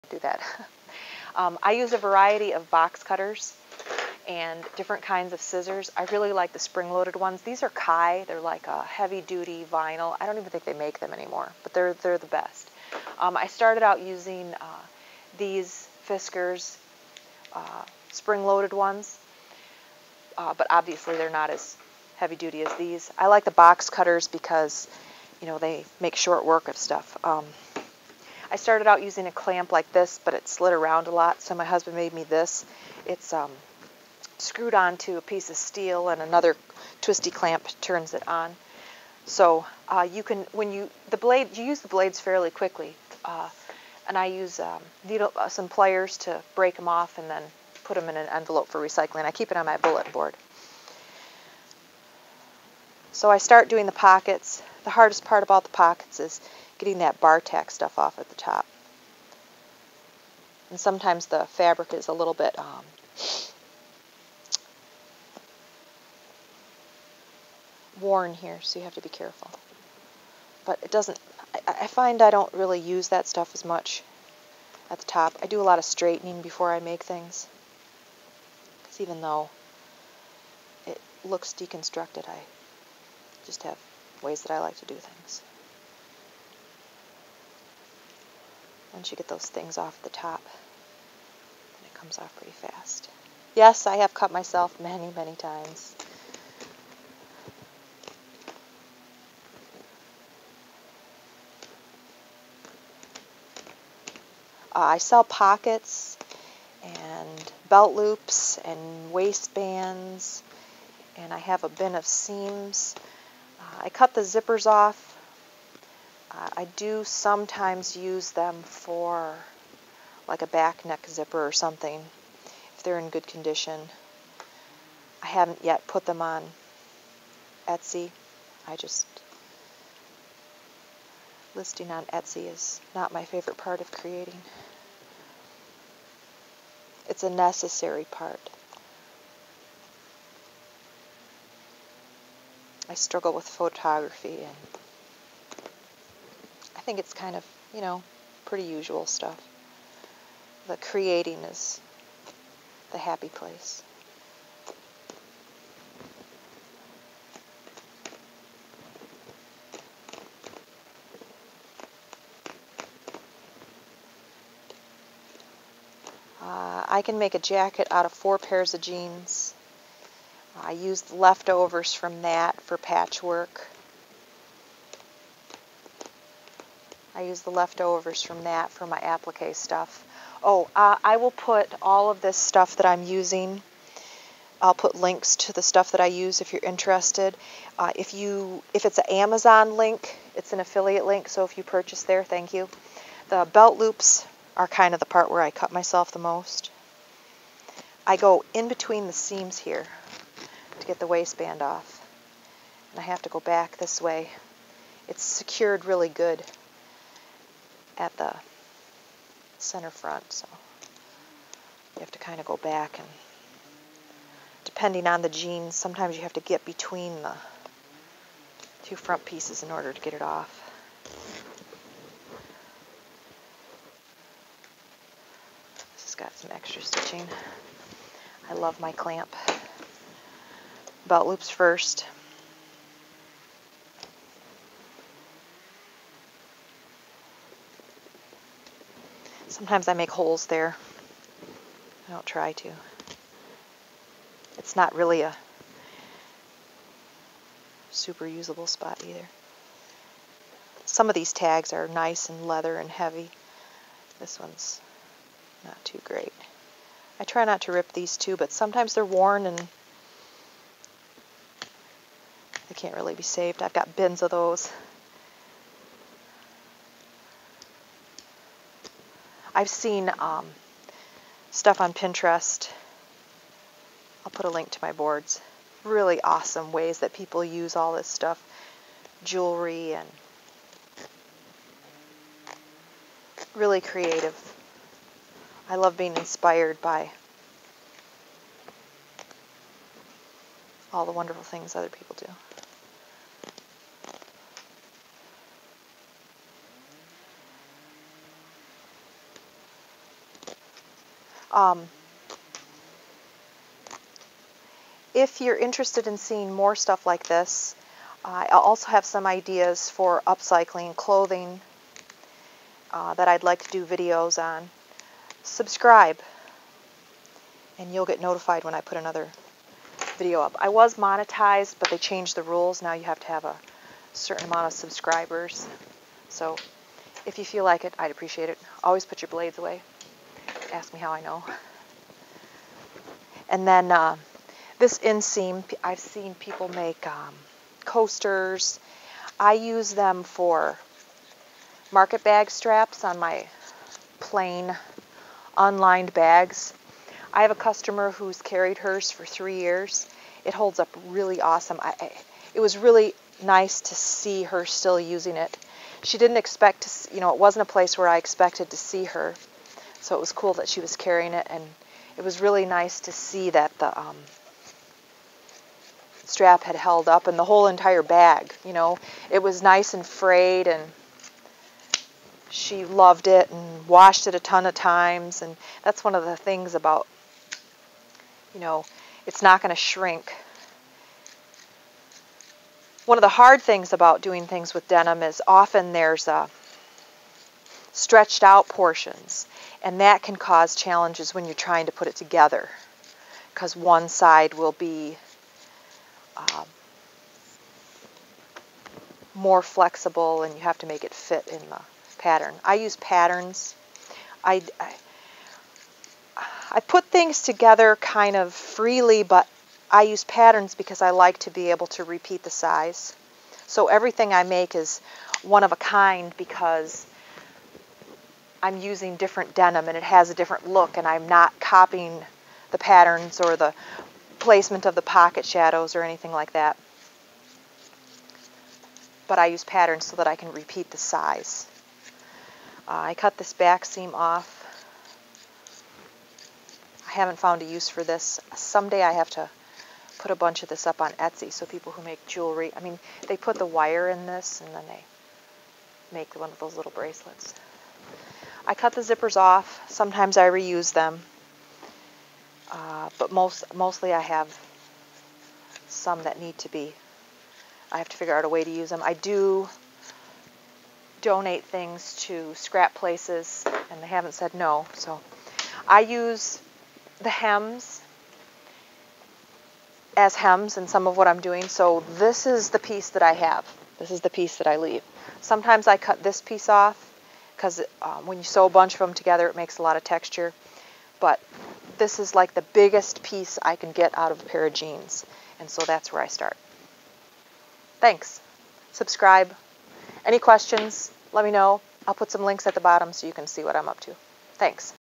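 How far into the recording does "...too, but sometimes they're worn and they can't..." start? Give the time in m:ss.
4:18.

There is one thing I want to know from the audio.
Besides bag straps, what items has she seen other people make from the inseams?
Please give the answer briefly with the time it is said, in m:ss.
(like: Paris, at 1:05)
Coasters, at 5:37.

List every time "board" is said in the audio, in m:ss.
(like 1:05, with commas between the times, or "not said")
0:50, 4:34.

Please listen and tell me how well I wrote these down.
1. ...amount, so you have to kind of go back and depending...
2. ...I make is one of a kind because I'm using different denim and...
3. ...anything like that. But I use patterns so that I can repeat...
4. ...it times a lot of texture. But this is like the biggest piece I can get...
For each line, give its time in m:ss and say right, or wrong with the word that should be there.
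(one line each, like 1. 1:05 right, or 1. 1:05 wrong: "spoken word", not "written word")
1. 3:29 wrong: "front", not "amount"
2. 6:54 right
3. 7:06 right
4. 7:59 wrong: "makes", not "times".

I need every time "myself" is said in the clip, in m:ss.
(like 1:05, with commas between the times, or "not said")
1:34, 3:15.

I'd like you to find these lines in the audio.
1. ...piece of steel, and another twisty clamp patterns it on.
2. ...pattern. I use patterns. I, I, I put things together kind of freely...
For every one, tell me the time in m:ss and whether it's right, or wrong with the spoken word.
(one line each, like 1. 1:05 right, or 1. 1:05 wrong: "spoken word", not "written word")
1. 0:35 wrong: "turns", not "patterns"
2. 6:42 right.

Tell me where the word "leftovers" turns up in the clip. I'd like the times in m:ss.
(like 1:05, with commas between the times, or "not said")
2:51, 2:57.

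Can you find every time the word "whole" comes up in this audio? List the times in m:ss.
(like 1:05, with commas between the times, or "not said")
6:07.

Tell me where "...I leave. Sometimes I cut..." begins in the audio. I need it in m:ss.
7:54.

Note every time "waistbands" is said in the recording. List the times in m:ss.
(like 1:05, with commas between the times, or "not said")
1:49, 3:21.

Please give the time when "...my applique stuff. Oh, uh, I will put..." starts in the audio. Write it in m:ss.
2:58.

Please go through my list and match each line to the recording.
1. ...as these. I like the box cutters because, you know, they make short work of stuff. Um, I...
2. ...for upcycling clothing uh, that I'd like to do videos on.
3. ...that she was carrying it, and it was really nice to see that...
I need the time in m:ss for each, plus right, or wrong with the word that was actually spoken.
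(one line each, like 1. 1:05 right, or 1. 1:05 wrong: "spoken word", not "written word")
1. 0:22 right
2. 5:09 right
3. 6:00 right.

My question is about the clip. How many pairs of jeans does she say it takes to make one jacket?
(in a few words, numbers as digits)
4.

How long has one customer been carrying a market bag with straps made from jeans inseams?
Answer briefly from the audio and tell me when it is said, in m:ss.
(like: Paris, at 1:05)
3 years, at 5:49.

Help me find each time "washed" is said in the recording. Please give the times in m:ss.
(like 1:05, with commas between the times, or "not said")
6:13.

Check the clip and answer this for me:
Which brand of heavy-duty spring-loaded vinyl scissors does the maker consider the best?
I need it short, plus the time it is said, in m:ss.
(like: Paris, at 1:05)
Kai, at 0:07.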